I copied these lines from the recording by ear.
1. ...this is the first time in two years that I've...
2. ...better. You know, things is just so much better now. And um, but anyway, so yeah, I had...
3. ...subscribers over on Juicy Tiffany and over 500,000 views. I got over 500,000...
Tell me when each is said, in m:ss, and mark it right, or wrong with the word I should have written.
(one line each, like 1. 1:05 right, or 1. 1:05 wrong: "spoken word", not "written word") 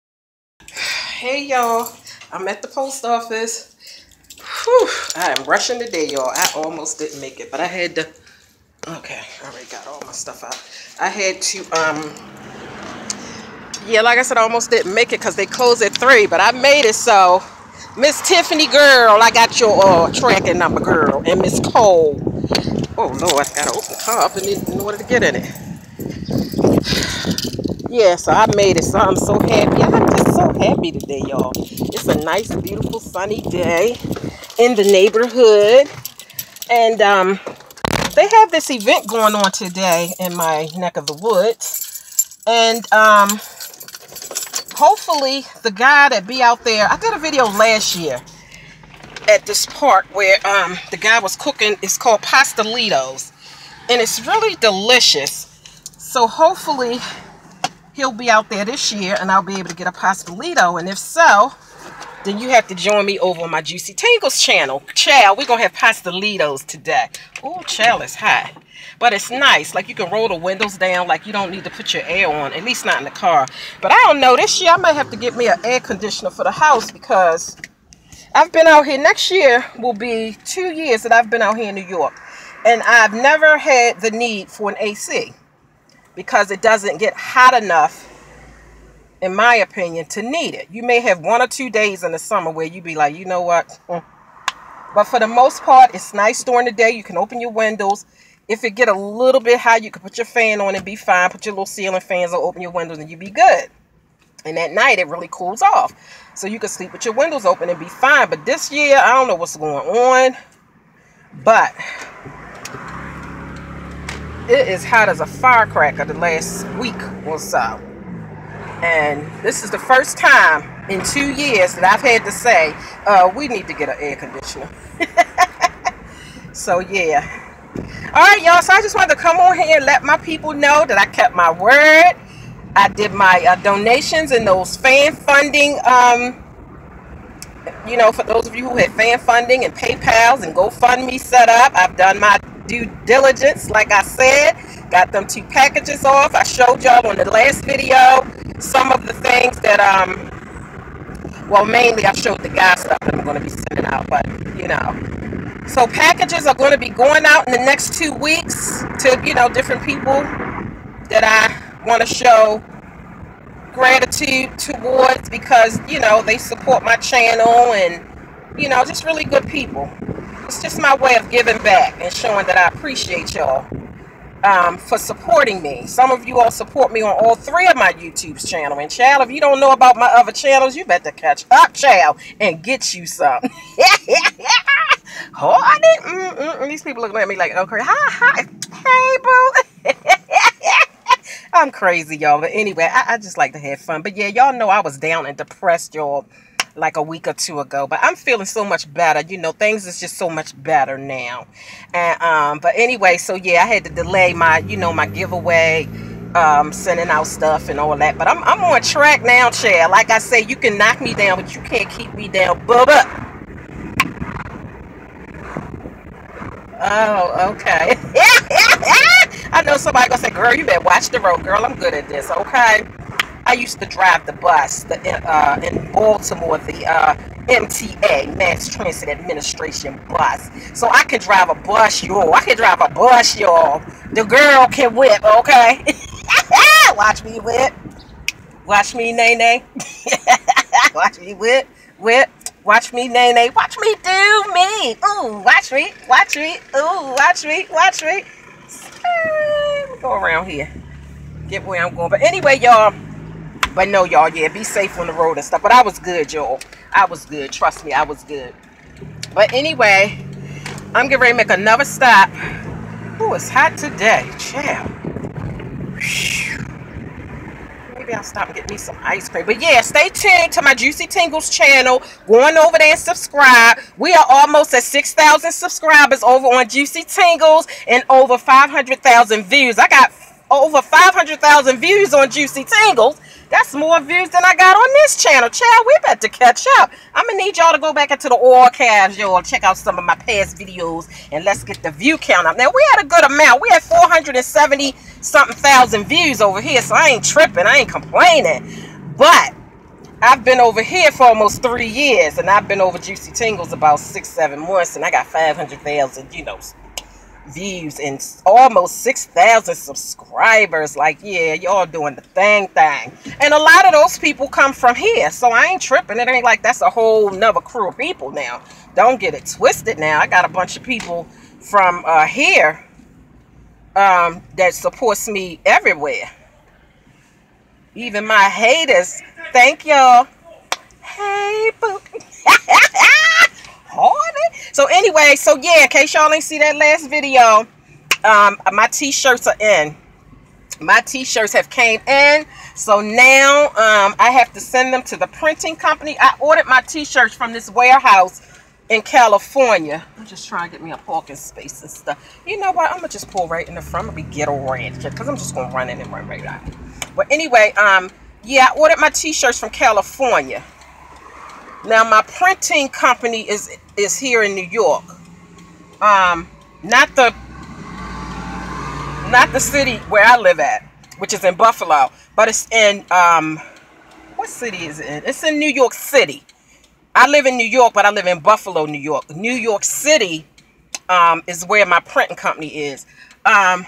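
1. 1:59 right
2. 3:18 right
3. 4:35 wrong: "Tingles", not "Tiffany".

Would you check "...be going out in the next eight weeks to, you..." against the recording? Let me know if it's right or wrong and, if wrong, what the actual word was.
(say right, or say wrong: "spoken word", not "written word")
wrong: "two", not "eight".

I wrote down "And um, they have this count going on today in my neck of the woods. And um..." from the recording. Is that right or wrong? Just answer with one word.
wrong.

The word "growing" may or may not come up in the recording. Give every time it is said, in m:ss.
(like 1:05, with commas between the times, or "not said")
not said.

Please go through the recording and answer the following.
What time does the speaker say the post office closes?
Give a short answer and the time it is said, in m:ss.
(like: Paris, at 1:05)
3, at 0:15.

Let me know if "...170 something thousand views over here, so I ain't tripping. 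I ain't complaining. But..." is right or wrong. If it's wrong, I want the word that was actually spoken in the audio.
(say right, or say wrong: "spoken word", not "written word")
wrong: "470", not "170".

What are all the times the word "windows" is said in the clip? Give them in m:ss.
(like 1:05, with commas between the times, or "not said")
1:10, 1:37, 1:42, 1:47.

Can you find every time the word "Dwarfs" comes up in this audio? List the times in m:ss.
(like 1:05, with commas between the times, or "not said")
not said.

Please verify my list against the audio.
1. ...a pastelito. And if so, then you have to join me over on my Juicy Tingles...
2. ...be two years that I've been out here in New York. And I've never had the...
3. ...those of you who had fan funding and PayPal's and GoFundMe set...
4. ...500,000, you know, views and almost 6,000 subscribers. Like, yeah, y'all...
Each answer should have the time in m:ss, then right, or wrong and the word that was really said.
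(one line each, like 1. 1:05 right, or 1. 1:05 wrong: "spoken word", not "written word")
1. 0:59 right
2. 1:19 right
3. 2:18 right
4. 5:05 right.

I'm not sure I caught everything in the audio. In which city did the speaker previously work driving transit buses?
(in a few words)
Baltimore.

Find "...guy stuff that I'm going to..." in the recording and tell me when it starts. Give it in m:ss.
2:32.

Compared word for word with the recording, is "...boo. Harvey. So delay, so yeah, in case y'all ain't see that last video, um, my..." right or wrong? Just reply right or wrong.
wrong.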